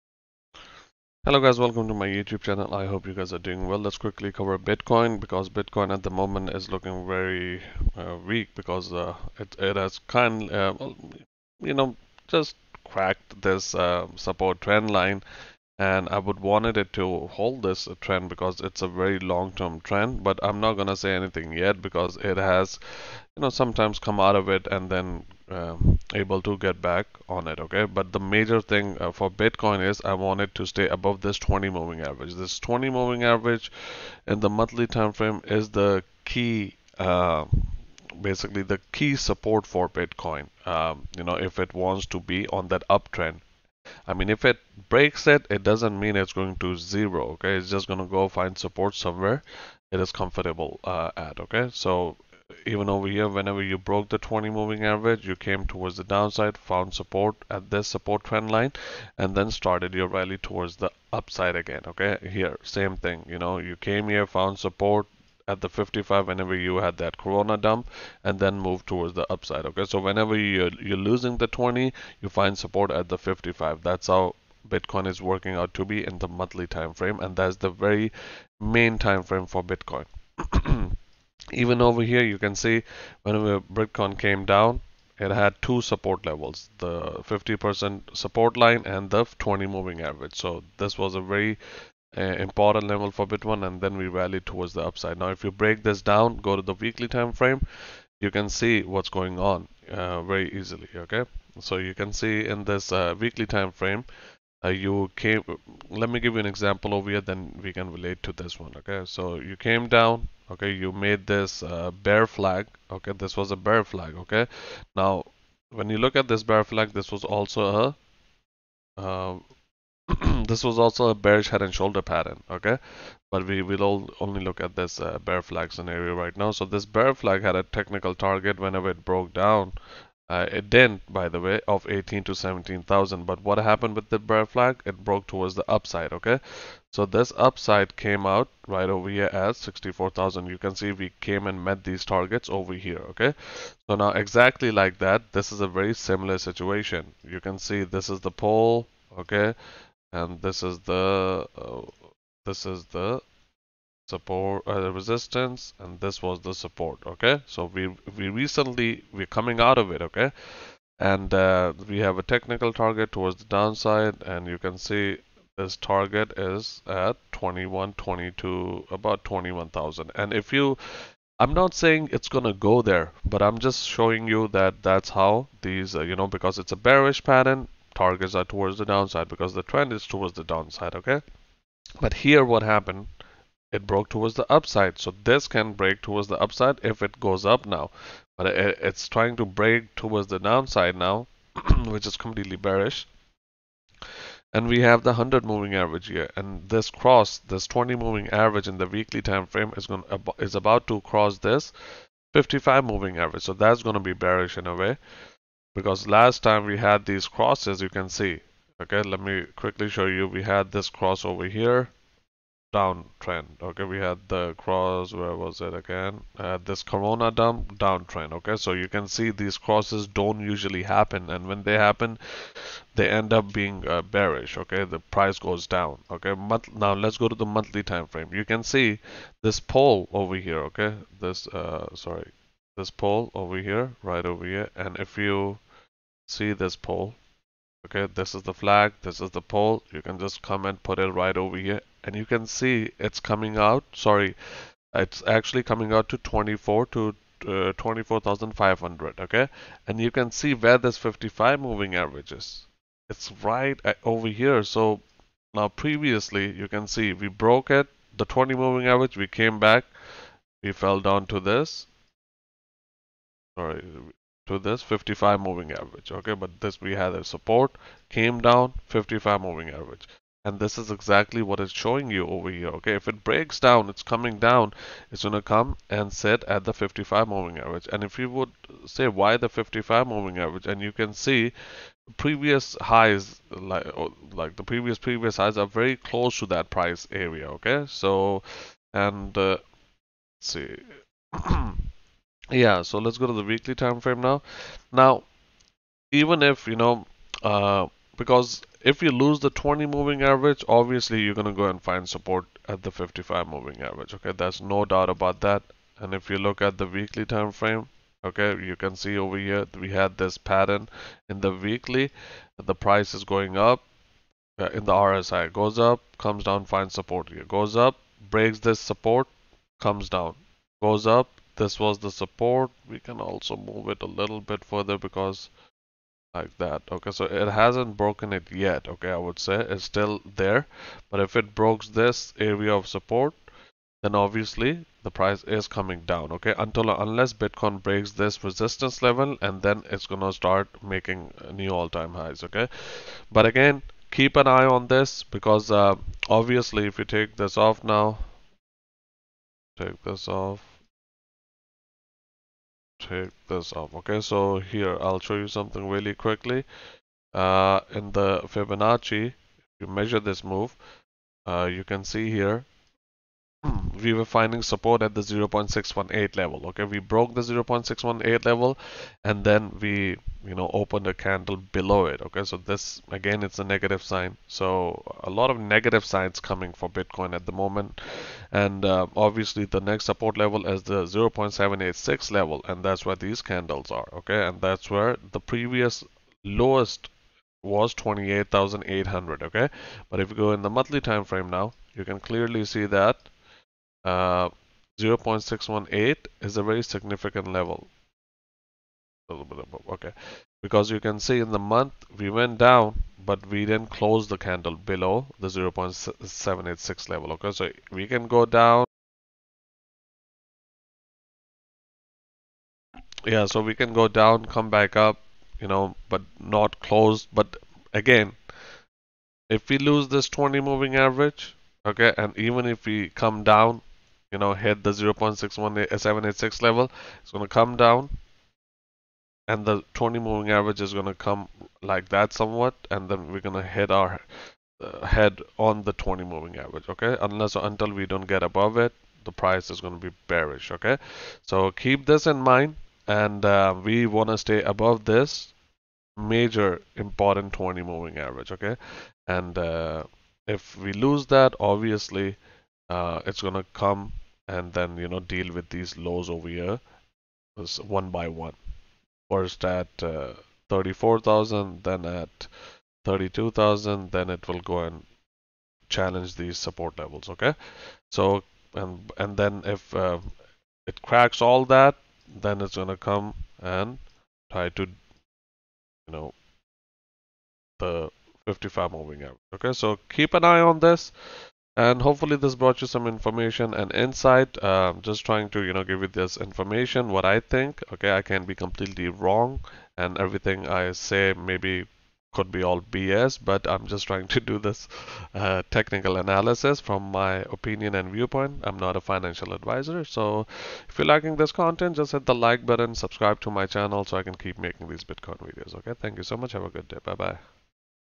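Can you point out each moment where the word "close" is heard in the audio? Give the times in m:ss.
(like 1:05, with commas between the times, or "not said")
4:45, 6:43, 6:56.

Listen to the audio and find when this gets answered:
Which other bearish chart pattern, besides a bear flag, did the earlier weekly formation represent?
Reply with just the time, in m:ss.
2:01.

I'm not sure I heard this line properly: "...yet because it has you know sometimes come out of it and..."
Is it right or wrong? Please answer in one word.
right.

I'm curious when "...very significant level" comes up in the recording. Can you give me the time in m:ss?
6:36.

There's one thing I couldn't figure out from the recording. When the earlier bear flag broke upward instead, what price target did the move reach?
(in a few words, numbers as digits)
64,000.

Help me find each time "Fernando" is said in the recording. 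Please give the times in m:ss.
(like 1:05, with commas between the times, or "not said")
not said.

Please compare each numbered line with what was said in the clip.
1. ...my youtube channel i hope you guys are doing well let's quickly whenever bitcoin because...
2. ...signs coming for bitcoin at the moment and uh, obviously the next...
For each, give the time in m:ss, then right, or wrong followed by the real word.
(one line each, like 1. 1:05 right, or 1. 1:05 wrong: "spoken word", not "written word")
1. 0:01 wrong: "cover", not "whenever"
2. 6:16 right.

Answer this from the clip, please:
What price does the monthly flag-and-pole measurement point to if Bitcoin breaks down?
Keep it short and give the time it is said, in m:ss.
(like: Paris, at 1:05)
24,500, at 4:07.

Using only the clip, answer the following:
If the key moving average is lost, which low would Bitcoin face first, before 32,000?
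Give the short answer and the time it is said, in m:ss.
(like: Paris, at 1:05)
34,000, at 7:40.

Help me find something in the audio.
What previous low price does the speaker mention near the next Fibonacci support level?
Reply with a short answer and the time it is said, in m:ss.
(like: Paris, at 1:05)
28800, at 6:27.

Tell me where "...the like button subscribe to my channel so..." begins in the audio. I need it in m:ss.
8:22.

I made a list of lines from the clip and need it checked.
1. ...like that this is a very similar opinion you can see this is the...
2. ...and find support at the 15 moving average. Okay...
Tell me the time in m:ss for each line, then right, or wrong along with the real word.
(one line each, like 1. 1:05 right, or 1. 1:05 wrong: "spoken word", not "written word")
1. 2:24 wrong: "situation", not "opinion"
2. 5:01 wrong: "55", not "15".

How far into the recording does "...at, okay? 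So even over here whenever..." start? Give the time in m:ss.
0:51.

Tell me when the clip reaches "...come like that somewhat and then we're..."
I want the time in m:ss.
7:11.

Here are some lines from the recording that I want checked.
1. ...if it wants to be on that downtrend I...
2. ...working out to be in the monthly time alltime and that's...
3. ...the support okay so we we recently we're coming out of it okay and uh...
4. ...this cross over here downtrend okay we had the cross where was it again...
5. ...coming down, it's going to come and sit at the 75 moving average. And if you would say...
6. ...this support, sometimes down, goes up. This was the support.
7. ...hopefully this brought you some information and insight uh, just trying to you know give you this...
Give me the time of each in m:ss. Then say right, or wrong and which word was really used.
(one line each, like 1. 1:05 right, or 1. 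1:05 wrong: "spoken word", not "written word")
1. 0:41 wrong: "uptrend", not "downtrend"
2. 1:15 wrong: "frame", not "alltime"
3. 2:36 right
4. 3:30 right
5. 4:34 wrong: "55", not "75"
6. 5:18 wrong: "comes", not "sometimes"
7. 8:02 right.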